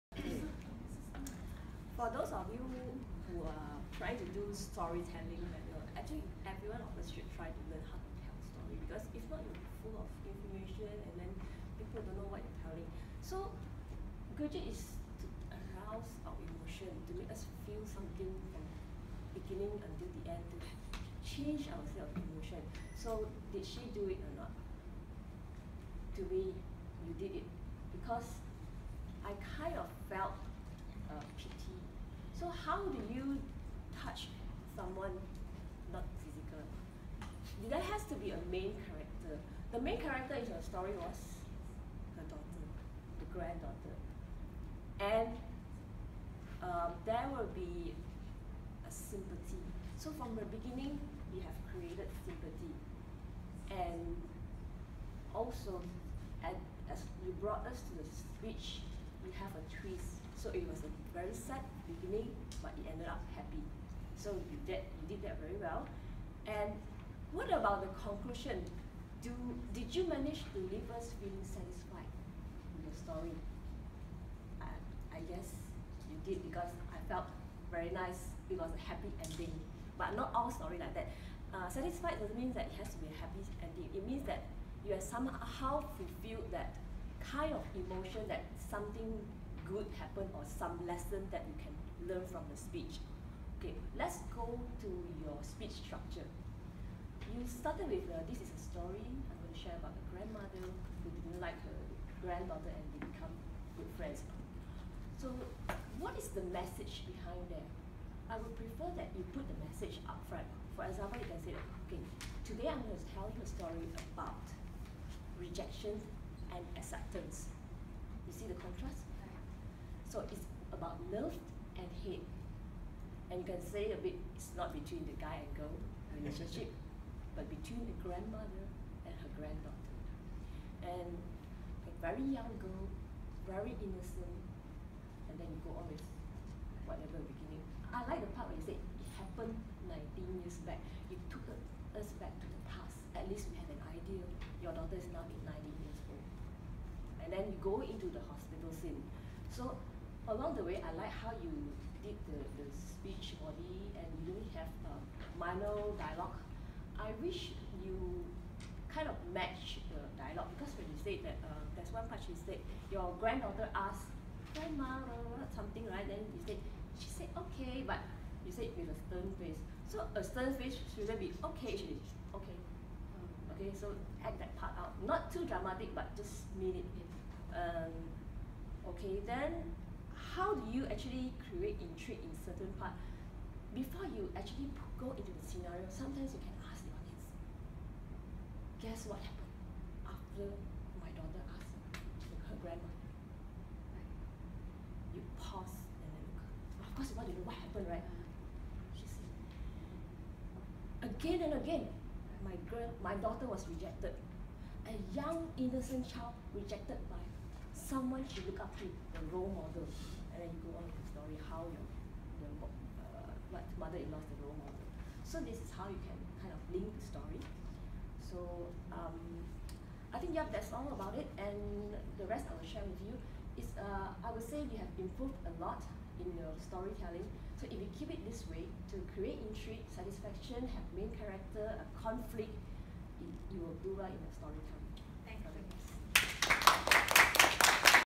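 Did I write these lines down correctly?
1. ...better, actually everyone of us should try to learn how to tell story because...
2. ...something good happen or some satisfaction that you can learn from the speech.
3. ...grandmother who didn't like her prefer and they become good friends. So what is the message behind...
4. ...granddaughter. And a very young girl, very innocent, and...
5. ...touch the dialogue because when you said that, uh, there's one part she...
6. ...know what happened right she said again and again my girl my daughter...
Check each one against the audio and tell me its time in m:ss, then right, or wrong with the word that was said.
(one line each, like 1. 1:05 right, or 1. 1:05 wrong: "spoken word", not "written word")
1. 0:05 right
2. 1:28 wrong: "lesson", not "satisfaction"
3. 1:40 wrong: "granddaughter", not "prefer"
4. 2:09 right
5. 2:39 wrong: "match", not "touch"
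6. 3:17 right.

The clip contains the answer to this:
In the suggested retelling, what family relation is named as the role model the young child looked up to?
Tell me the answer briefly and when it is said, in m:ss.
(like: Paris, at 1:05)
mother-in-law, at 3:33.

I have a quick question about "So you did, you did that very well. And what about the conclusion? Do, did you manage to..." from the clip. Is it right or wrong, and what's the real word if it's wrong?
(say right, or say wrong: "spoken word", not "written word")
right.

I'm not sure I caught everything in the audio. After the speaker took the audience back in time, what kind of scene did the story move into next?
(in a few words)
hospital scene.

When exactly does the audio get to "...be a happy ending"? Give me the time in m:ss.
1:22.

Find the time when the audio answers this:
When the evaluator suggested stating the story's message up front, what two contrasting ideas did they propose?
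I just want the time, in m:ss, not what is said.
1:55.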